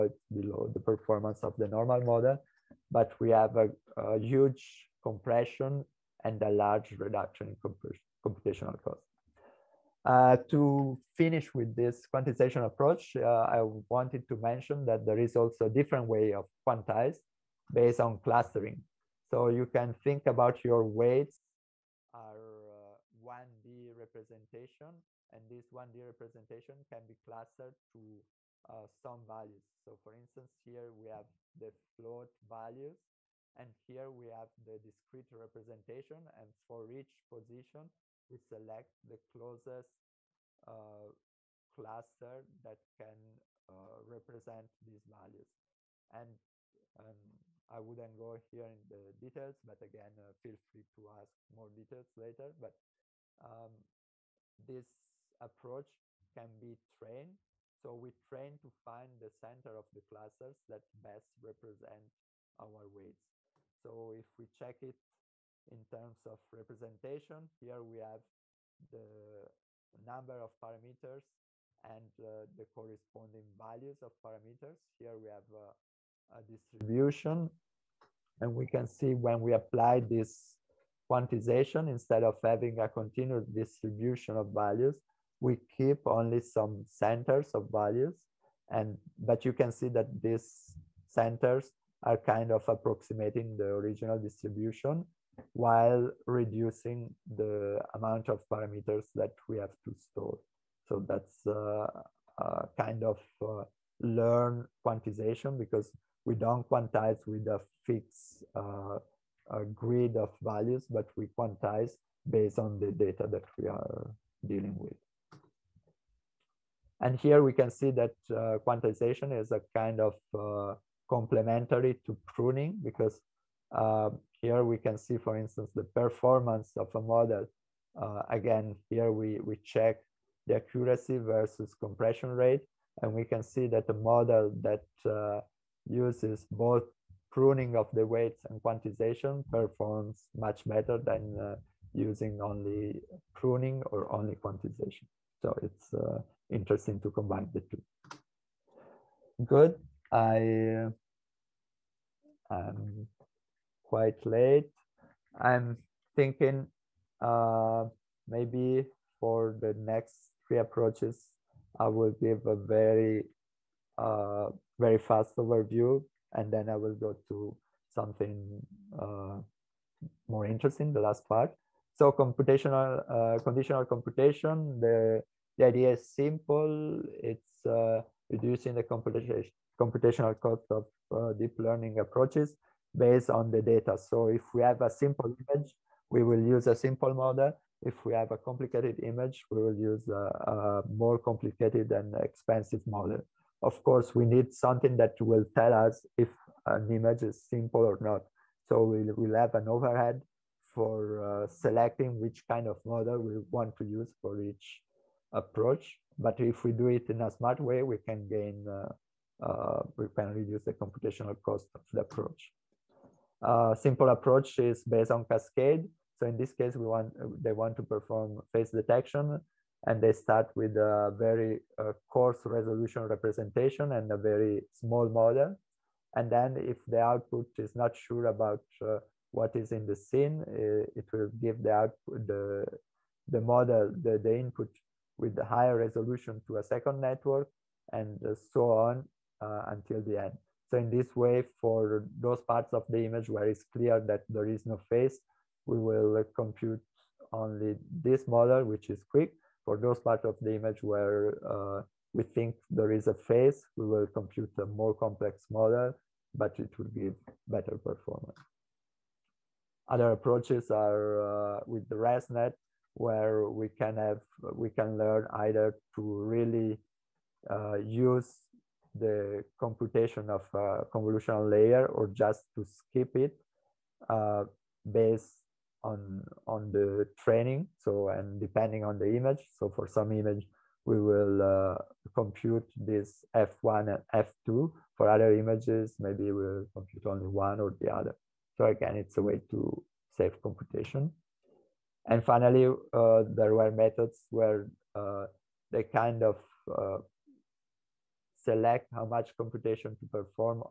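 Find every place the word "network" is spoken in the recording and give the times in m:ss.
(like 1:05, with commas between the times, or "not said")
3:56.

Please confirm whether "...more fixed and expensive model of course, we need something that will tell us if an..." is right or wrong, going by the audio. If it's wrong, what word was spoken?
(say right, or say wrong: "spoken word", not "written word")
wrong: "complicated", not "fixed".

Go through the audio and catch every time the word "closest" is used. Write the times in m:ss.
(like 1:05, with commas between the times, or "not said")
0:39.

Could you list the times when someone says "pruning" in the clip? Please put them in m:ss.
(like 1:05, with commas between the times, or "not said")
2:02, 2:17, 2:23.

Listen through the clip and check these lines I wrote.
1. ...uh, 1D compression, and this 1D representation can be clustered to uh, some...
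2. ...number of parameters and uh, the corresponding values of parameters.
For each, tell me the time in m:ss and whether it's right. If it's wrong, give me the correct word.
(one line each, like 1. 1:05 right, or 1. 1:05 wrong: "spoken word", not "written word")
1. 0:22 wrong: "representation", not "compression"
2. 1:09 right.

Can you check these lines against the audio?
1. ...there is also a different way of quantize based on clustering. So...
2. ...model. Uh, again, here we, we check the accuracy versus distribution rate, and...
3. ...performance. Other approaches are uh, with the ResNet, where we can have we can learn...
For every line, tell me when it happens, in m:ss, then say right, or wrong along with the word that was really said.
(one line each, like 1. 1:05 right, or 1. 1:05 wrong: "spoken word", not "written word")
1. 0:15 right
2. 2:06 wrong: "compression", not "distribution"
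3. 4:17 right.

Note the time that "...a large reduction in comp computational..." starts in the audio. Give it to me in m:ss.
0:06.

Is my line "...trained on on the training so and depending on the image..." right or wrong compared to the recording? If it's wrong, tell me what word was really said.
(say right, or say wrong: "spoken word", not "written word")
wrong: "based", not "trained".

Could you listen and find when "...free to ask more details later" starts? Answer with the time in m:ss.
0:50.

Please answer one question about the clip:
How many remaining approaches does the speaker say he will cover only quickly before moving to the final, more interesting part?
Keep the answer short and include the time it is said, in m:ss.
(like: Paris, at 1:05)
3, at 2:40.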